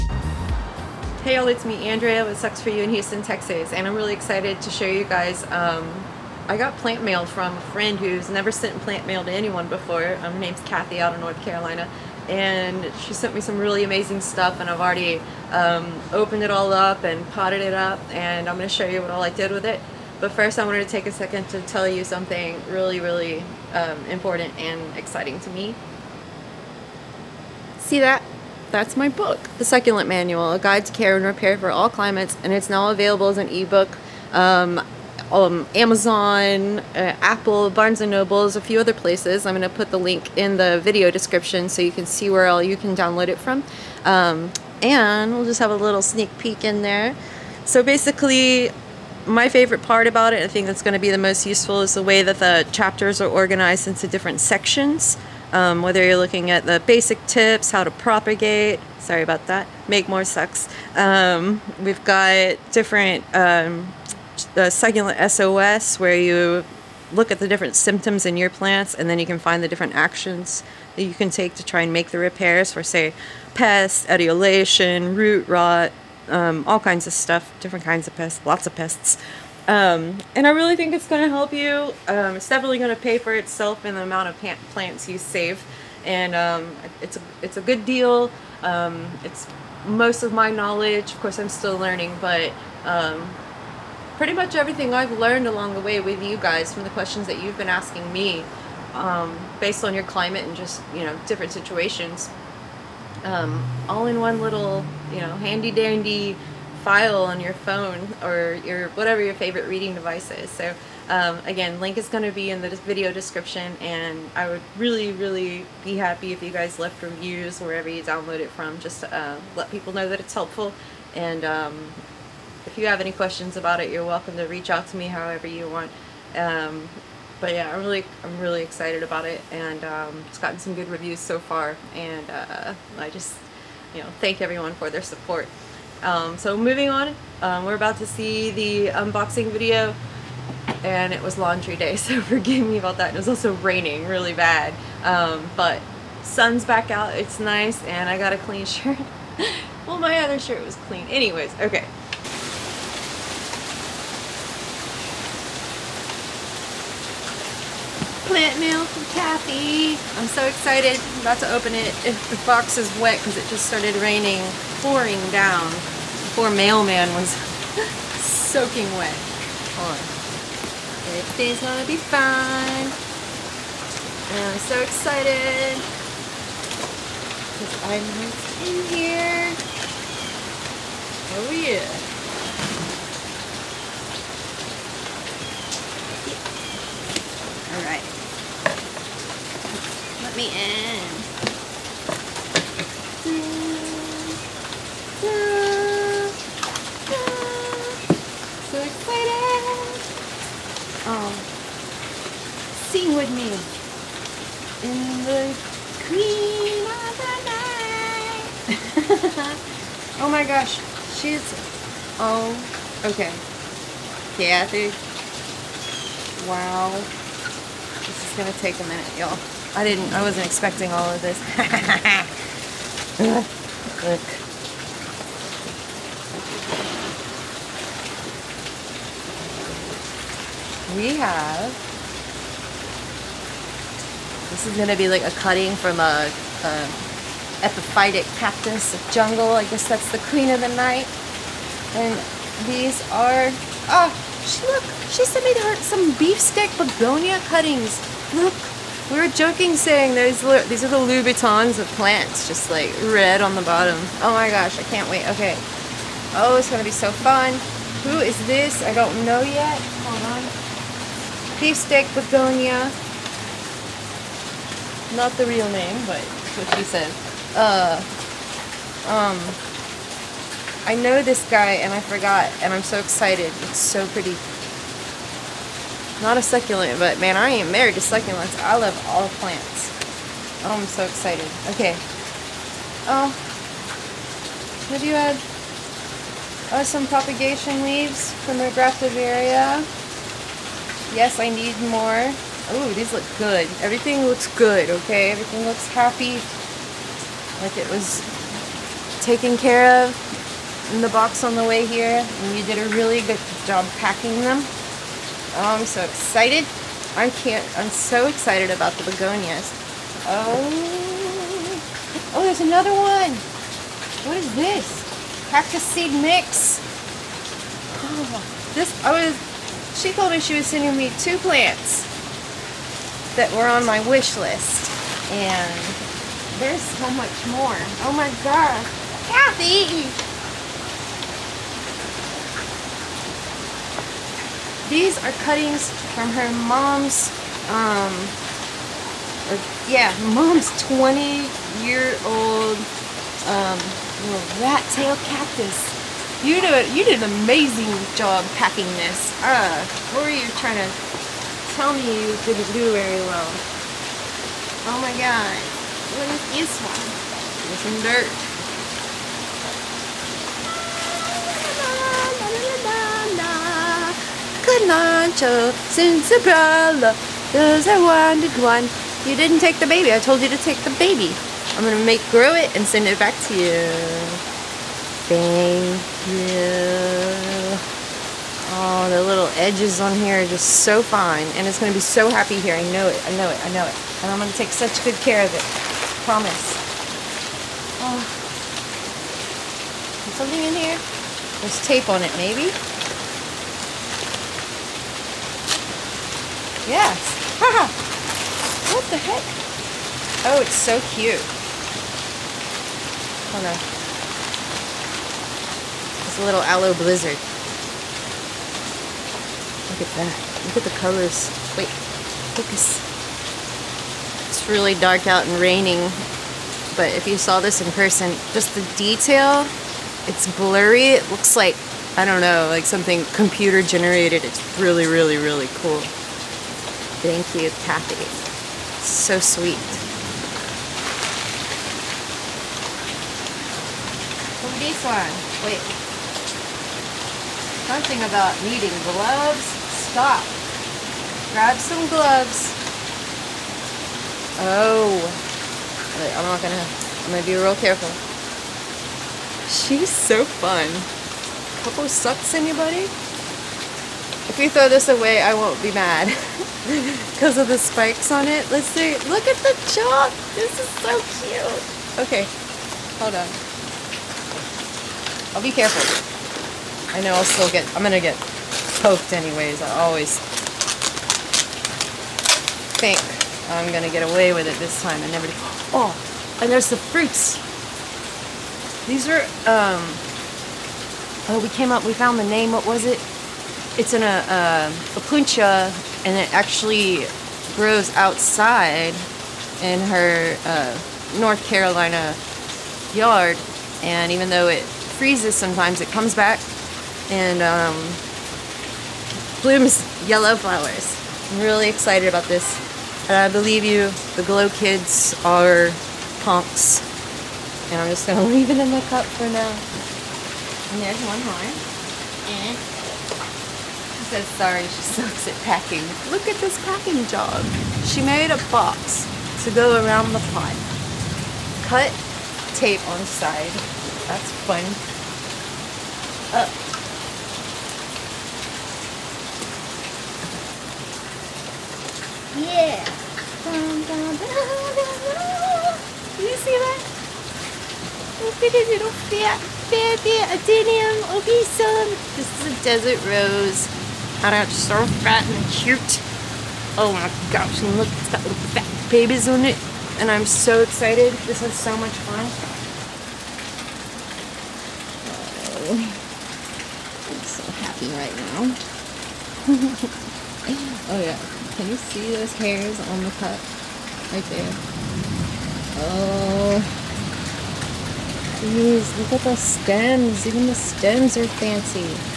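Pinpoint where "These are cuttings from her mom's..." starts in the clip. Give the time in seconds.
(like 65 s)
334 s.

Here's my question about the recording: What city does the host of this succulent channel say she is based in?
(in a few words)
Houston.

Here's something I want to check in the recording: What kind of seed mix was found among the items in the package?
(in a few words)
Cactus seed mix.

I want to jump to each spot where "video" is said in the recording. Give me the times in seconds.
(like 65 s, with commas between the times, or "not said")
40 s, 112 s, 139 s.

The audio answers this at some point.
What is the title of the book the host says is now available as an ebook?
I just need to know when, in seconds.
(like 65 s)
29 s.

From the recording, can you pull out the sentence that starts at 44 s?
Um, and we'll just have a little sneak peek in there.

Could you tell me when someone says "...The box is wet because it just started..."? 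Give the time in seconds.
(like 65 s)
162 s.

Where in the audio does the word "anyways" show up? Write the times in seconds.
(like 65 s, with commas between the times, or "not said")
151 s, 469 s.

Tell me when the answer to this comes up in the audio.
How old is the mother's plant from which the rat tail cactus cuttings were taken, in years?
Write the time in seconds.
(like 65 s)
340 s.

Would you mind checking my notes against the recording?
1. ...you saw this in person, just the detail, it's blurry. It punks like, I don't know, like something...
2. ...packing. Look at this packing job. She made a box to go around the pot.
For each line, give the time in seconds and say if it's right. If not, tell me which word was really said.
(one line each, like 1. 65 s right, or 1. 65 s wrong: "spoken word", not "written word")
1. 417 s wrong: "looks", not "punks"
2. 515 s right.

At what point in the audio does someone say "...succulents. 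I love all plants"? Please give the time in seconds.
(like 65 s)
277 s.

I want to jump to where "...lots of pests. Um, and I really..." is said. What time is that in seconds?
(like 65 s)
78 s.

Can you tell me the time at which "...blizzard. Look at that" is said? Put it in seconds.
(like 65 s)
406 s.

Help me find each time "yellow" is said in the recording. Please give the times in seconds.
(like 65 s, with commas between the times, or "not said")
500 s.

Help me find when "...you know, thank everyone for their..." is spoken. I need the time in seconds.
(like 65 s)
133 s.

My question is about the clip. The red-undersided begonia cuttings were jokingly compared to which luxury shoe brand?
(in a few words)
Louboutins.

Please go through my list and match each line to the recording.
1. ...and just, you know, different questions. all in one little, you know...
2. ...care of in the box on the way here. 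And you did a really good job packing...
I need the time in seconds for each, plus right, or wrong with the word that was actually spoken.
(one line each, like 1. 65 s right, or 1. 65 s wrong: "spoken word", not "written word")
1. 100 s wrong: "situations", not "questions"
2. 299 s right.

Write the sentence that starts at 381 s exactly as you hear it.
And it's going to be so happy here.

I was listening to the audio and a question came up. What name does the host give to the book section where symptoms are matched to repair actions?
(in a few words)
succulent SOS.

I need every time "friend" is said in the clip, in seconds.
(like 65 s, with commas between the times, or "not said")
7 s.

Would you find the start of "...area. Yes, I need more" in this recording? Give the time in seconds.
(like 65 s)
289 s.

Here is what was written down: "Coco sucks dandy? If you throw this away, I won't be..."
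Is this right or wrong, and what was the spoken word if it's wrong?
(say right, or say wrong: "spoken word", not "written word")
wrong: "anybody", not "dandy".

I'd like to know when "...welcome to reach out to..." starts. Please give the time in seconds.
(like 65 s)
124 s.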